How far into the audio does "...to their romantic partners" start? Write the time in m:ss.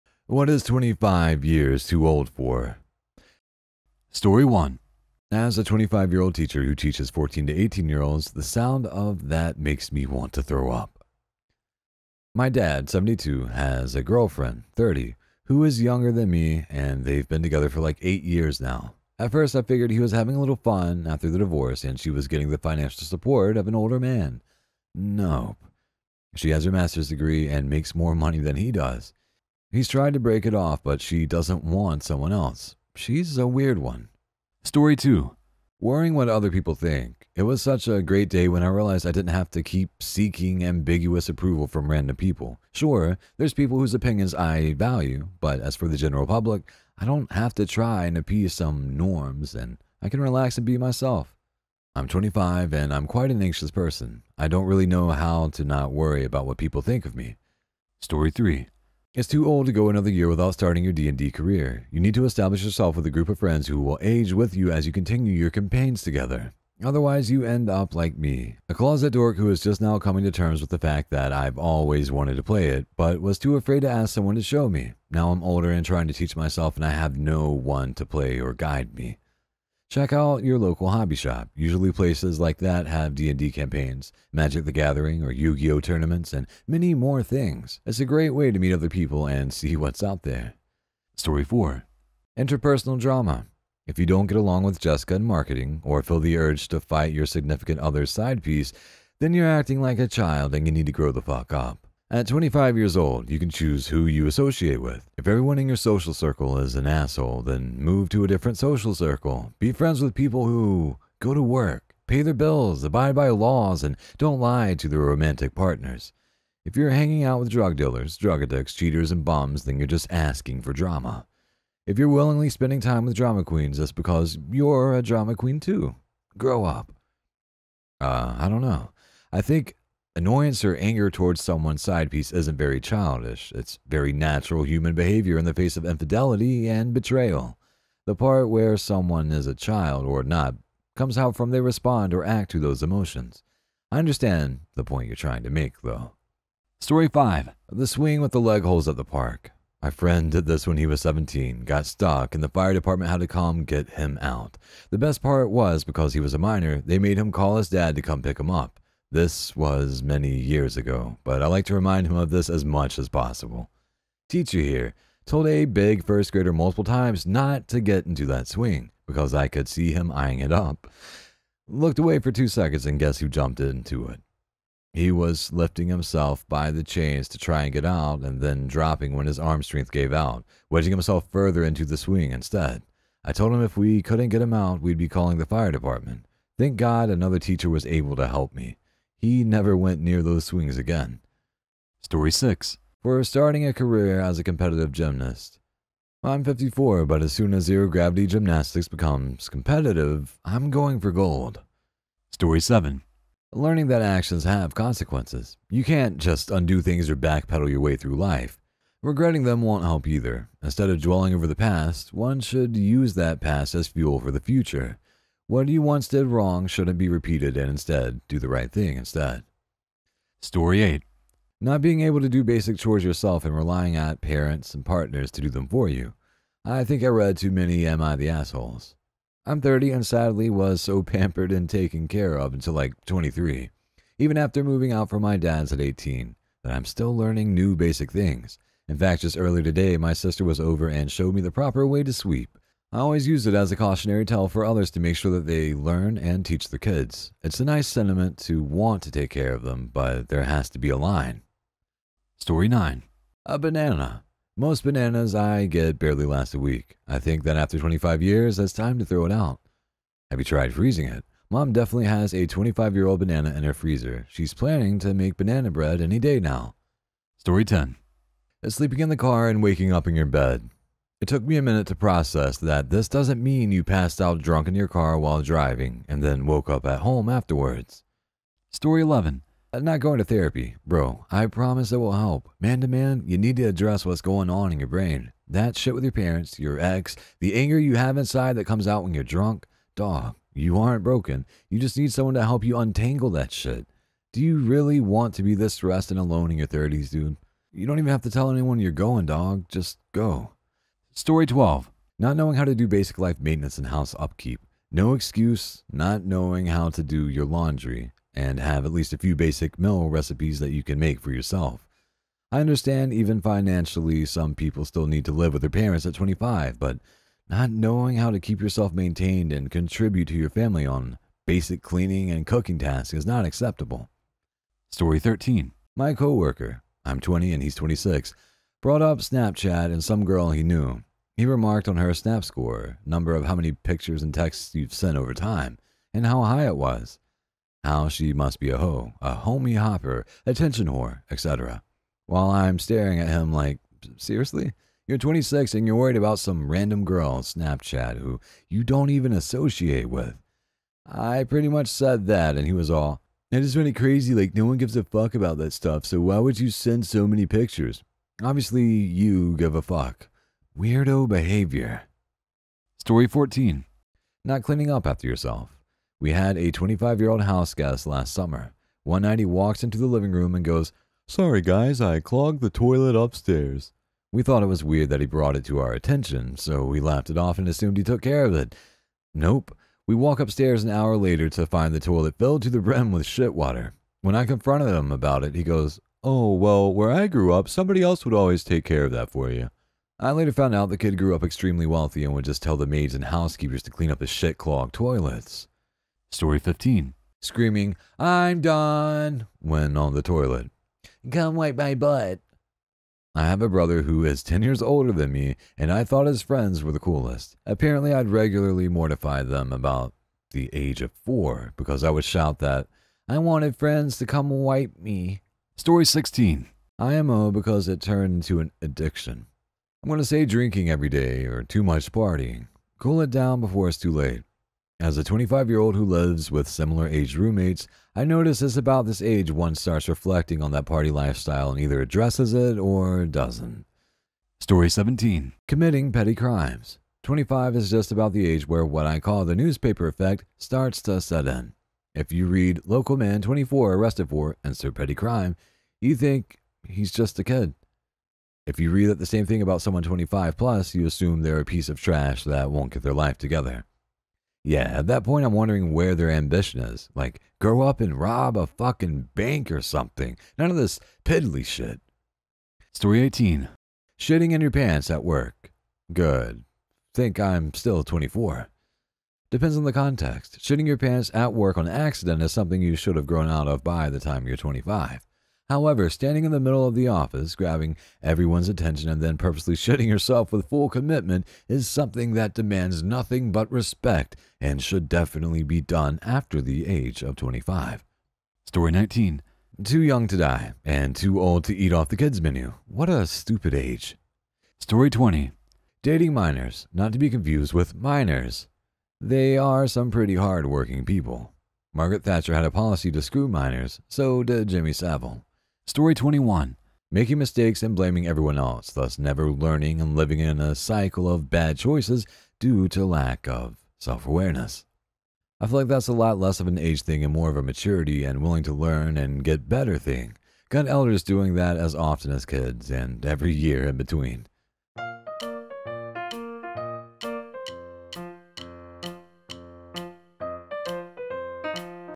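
1:54.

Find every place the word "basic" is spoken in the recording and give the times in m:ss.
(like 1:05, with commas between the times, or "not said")
3:42, 3:57, 5:02, 5:09, 5:21.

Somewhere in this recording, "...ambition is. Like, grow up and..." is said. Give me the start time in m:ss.
7:36.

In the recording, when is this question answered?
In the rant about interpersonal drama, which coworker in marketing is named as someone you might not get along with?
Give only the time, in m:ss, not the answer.
1:34.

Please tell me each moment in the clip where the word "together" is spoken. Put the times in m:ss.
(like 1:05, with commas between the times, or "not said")
0:17, 1:06, 7:33.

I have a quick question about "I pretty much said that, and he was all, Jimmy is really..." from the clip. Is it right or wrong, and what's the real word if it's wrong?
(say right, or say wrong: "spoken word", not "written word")
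wrong: "That", not "Jimmy".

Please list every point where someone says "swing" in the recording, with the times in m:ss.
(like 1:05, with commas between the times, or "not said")
2:27, 2:48, 3:01, 3:10.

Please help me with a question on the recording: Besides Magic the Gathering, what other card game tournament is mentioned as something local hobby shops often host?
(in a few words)
Yu-Gi-Oh.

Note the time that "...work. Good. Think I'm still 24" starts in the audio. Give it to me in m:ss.
7:45.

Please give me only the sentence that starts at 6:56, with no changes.
IMO because it turned into an addiction.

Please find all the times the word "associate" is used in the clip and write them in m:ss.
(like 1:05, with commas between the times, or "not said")
1:44, 5:49.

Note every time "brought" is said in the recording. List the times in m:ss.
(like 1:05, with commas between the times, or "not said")
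5:28, 6:15.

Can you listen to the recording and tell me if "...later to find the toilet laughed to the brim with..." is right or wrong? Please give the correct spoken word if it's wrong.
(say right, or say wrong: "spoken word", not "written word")
wrong: "filled", not "laughed".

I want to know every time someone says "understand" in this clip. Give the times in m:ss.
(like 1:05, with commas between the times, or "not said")
2:23, 5:12.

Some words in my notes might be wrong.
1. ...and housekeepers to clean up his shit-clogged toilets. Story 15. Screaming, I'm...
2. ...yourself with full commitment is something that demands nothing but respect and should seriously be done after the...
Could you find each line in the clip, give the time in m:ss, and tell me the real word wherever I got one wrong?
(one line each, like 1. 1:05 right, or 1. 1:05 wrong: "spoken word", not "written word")
1. 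6:33 right
2. 8:00 wrong: "definitely", not "seriously".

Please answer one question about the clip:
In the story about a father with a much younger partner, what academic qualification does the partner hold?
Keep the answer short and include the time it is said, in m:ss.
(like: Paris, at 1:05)
Master's degree, at 0:26.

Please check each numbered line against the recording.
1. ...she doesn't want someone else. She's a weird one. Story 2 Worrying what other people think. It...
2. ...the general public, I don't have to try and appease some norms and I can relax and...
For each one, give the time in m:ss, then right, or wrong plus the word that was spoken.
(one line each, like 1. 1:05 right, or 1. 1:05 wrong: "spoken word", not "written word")
1. 0:30 right
2. 0:45 right.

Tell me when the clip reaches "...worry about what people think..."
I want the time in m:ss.
0:55.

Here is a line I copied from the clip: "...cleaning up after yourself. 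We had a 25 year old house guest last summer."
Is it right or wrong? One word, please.
right.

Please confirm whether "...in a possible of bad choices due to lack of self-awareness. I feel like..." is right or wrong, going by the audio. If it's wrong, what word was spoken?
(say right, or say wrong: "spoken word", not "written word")
wrong: "cycle", not "possible".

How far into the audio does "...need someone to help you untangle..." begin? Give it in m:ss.
4:51.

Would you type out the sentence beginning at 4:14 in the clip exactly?
Most bananas I get barely last a week.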